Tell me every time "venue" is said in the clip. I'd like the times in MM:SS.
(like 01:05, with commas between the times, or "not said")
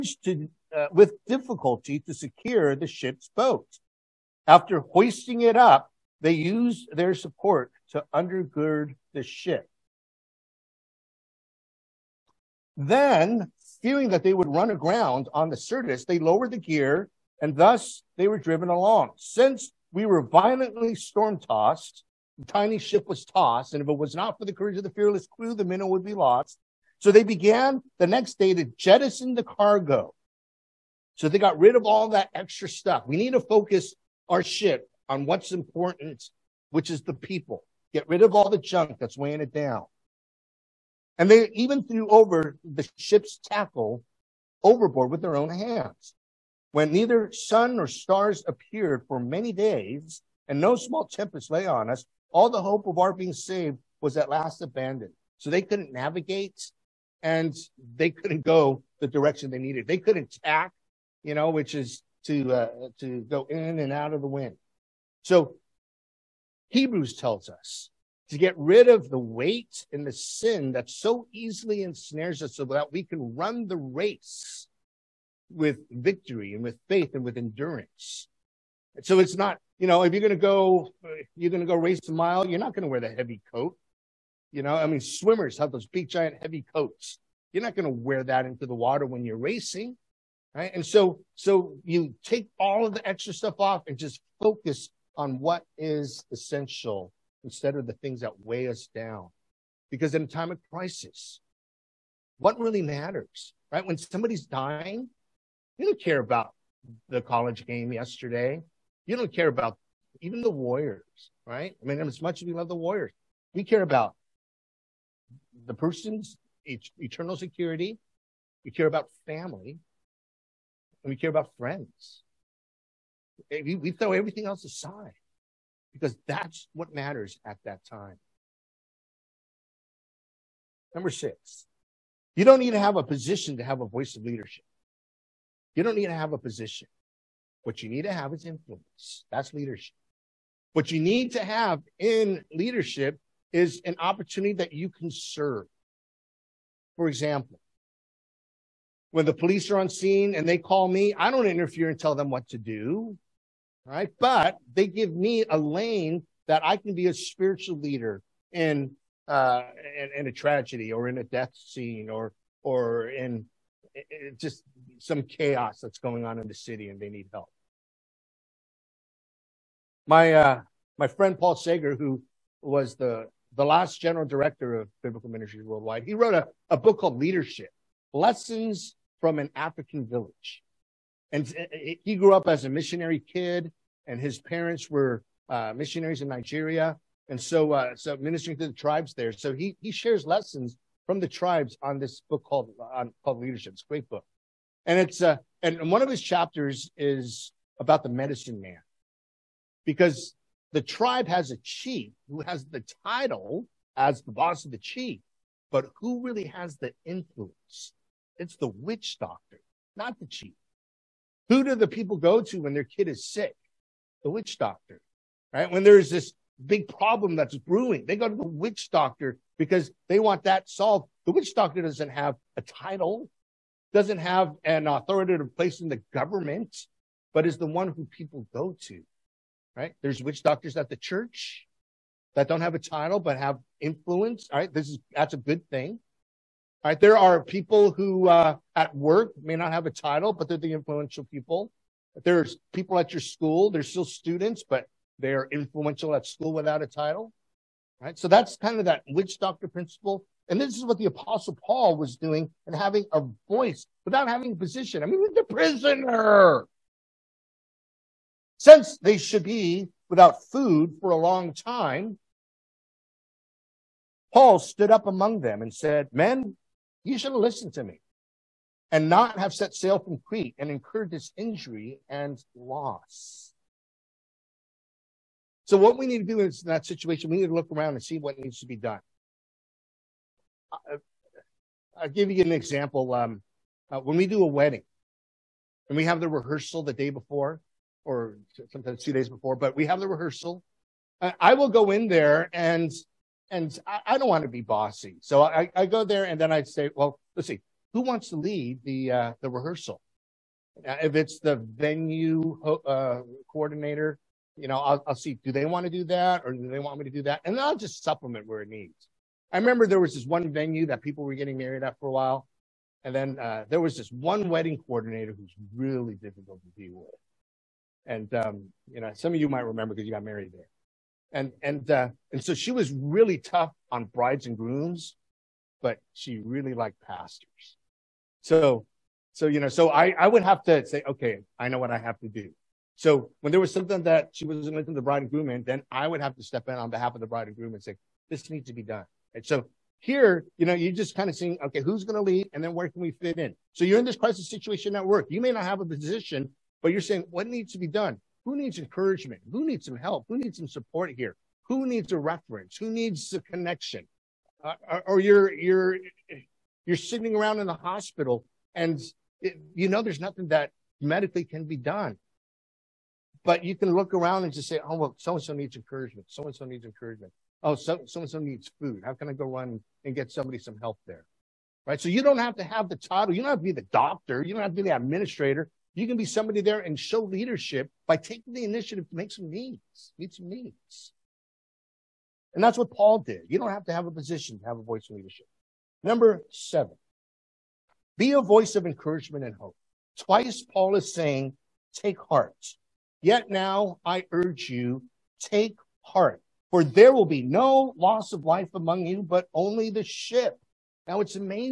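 05:01, 05:10.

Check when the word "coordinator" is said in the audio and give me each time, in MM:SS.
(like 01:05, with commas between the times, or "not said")
05:03, 05:14.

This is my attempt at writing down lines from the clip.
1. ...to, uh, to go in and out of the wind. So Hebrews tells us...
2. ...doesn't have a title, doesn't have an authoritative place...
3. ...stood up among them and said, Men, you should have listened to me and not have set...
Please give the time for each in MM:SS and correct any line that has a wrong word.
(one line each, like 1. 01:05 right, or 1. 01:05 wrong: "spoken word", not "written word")
1. 01:02 right
2. 03:41 right
3. 04:24 right.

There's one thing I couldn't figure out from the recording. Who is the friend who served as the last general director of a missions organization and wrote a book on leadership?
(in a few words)
Paul Seger.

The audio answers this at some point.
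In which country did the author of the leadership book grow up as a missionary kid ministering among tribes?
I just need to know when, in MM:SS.
03:06.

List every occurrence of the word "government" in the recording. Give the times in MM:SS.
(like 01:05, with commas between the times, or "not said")
03:46.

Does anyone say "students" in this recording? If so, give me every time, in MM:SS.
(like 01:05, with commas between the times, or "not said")
04:04.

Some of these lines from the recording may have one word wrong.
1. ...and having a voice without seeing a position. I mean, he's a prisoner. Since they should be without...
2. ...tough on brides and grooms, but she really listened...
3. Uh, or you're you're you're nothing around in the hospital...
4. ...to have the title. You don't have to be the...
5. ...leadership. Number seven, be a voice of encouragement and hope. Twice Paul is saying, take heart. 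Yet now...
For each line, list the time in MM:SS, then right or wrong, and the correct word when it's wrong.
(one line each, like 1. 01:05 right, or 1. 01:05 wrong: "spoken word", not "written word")
1. 04:12 wrong: "having", not "seeing"
2. 05:23 wrong: "liked", not "listened"
3. 05:54 wrong: "sitting", not "nothing"
4. 06:12 right
5. 06:25 right.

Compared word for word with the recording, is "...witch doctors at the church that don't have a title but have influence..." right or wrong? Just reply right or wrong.
right.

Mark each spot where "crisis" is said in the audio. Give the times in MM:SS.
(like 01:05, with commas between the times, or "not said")
01:40, 05:44.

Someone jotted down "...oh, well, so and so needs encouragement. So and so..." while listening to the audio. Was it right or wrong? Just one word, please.
right.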